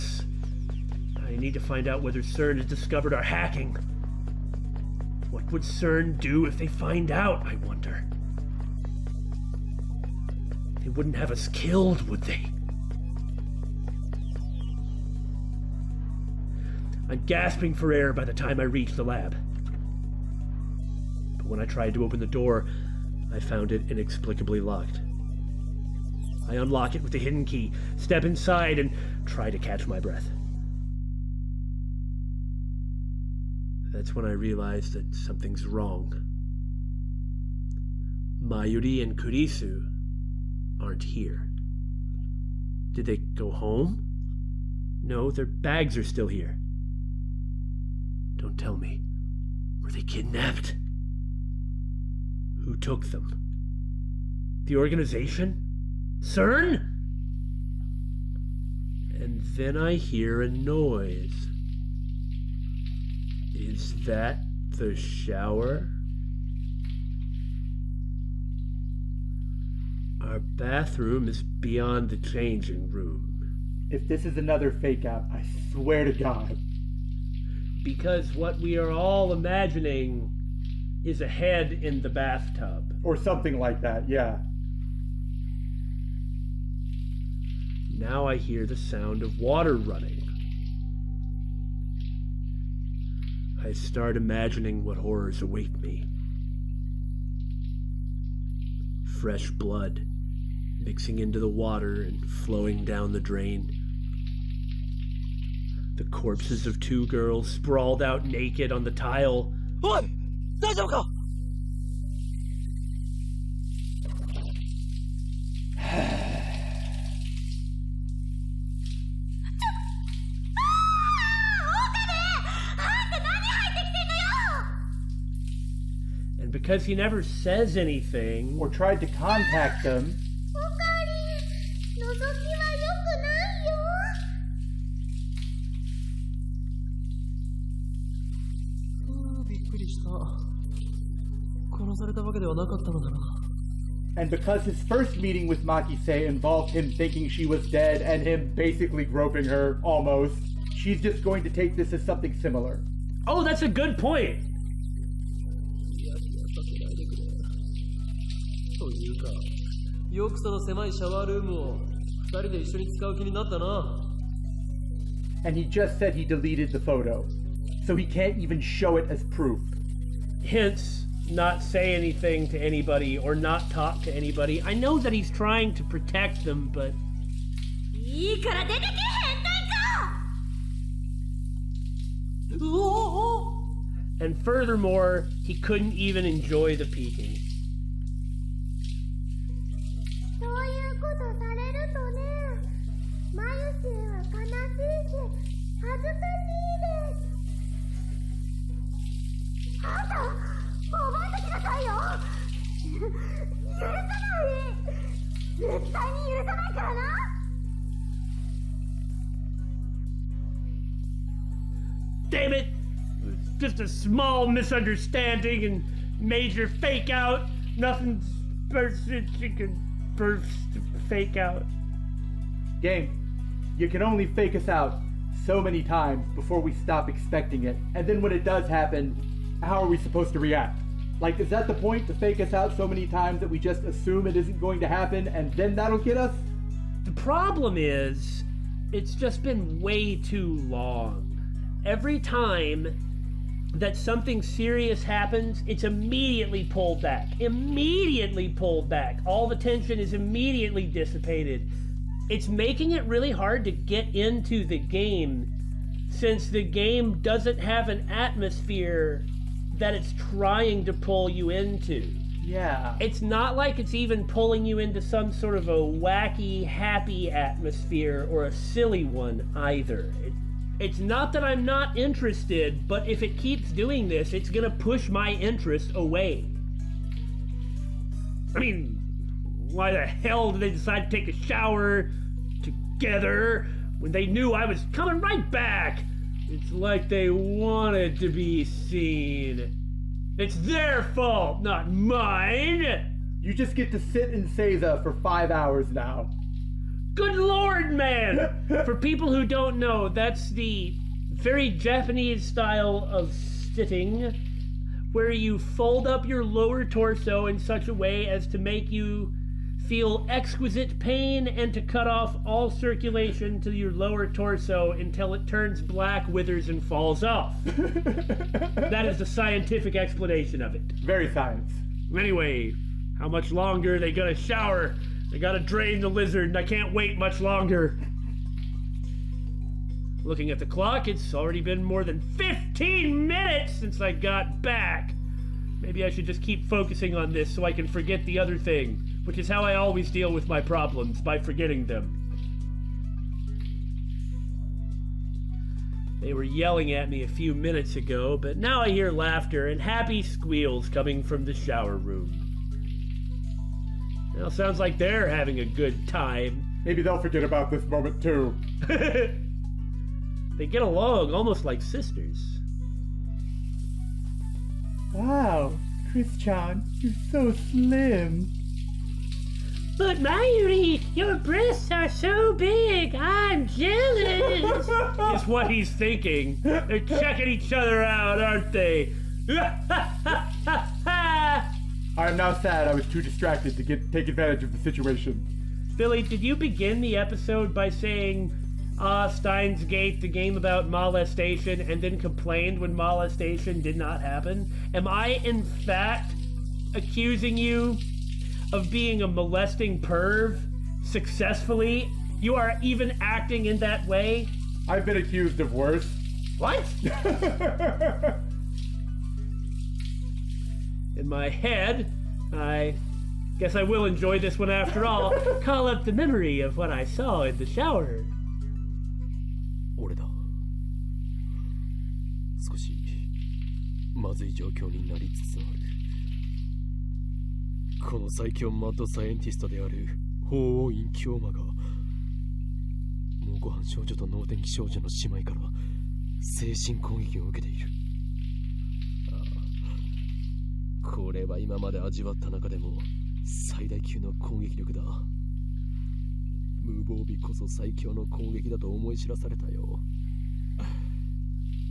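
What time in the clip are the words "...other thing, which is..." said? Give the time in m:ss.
5:38.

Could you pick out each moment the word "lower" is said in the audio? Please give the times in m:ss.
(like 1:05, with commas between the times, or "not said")
5:06, 5:13.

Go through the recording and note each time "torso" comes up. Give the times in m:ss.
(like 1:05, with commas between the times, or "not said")
5:06, 5:14.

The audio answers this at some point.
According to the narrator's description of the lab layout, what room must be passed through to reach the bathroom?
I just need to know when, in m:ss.
1:12.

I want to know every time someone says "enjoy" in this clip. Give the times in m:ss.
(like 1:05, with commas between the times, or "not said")
3:06, 6:54.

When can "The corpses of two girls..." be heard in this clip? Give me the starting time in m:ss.
1:45.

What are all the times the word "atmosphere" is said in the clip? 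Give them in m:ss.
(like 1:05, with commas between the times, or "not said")
4:18, 4:27.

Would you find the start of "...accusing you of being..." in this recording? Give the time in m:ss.
6:36.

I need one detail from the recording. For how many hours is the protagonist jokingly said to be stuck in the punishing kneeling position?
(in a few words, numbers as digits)
5.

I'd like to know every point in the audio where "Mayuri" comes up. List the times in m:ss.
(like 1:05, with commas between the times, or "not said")
0:38, 6:10.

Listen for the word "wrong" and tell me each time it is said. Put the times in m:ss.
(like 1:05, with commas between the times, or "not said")
0:35.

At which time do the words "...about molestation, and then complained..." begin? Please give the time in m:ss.
6:30.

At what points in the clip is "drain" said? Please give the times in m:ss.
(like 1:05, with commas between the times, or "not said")
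1:43, 5:25.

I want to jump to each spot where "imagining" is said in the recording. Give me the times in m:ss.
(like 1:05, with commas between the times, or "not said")
1:19, 1:34.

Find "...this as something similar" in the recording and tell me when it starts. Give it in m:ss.
2:31.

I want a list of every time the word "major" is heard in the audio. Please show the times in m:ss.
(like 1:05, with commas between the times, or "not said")
3:36.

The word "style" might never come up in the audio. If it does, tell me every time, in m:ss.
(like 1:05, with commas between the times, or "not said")
5:02.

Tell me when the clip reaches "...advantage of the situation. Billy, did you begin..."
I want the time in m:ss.
6:24.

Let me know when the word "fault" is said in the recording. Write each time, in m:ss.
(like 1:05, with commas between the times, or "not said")
4:51.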